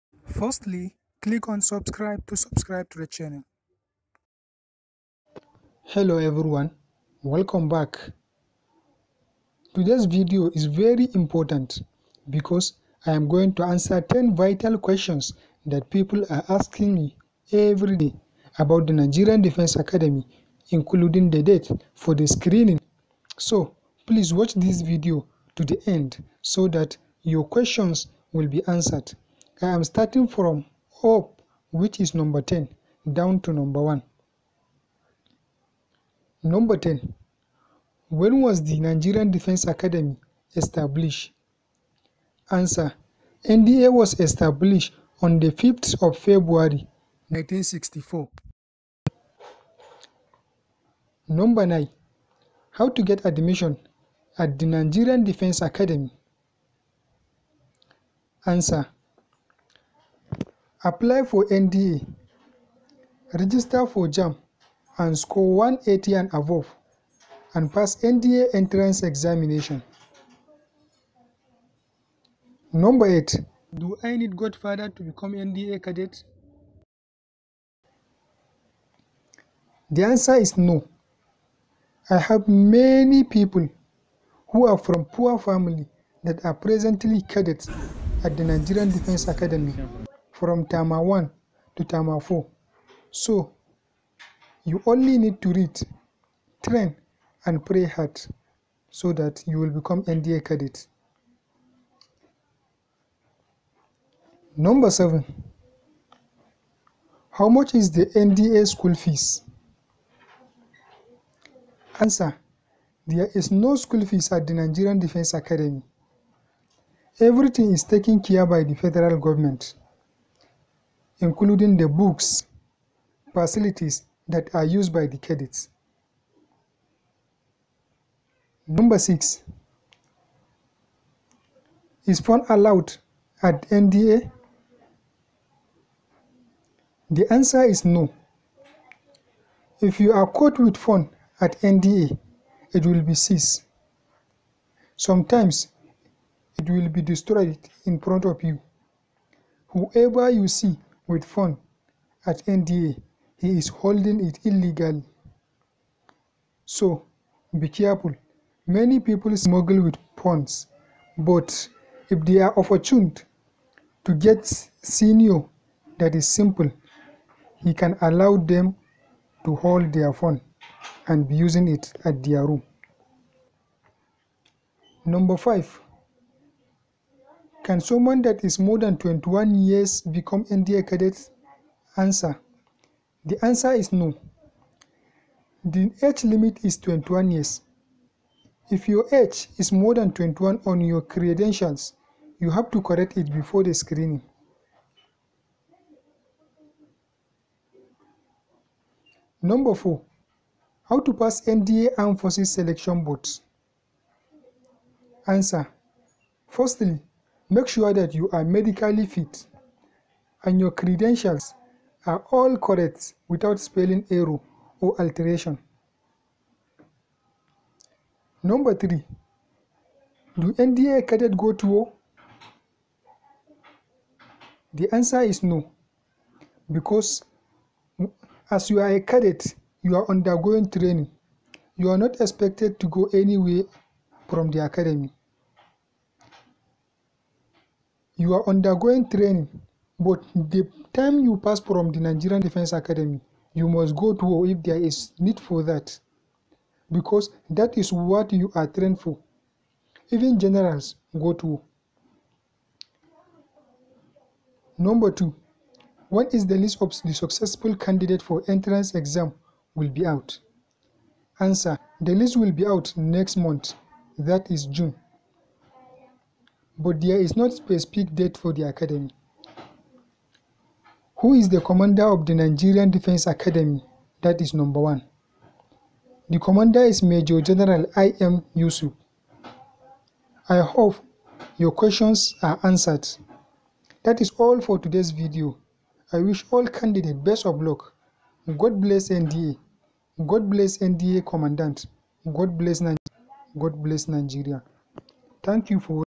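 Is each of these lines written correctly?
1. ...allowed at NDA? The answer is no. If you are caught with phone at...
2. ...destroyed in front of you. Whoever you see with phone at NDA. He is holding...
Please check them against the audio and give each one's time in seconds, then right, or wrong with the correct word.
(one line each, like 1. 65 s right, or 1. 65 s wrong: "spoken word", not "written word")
1. 132 s right
2. 147 s right.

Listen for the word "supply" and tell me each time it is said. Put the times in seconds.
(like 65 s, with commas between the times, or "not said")
not said.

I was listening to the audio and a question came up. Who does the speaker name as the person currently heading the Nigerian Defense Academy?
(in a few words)
Major General I. M. Yusuf.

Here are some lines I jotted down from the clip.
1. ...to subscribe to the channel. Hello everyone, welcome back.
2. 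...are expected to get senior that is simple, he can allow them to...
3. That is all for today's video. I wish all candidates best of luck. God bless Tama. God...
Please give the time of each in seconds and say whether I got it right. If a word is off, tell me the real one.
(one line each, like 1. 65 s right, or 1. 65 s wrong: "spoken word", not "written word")
1. 2 s right
2. 162 s wrong: "opportuned", not "expected"
3. 284 s wrong: "NDA", not "Tama".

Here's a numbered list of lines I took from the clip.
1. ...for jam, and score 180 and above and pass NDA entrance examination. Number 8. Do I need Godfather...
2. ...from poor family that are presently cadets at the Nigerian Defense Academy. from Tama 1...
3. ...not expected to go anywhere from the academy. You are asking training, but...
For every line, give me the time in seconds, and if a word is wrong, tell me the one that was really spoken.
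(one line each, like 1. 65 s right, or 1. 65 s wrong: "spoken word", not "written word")
1. 63 s right
2. 84 s right
3. 231 s wrong: "undergoing", not "asking".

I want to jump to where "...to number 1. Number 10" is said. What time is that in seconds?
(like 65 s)
33 s.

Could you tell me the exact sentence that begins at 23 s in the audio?
So please watch this video to the end so that your questions will be answered.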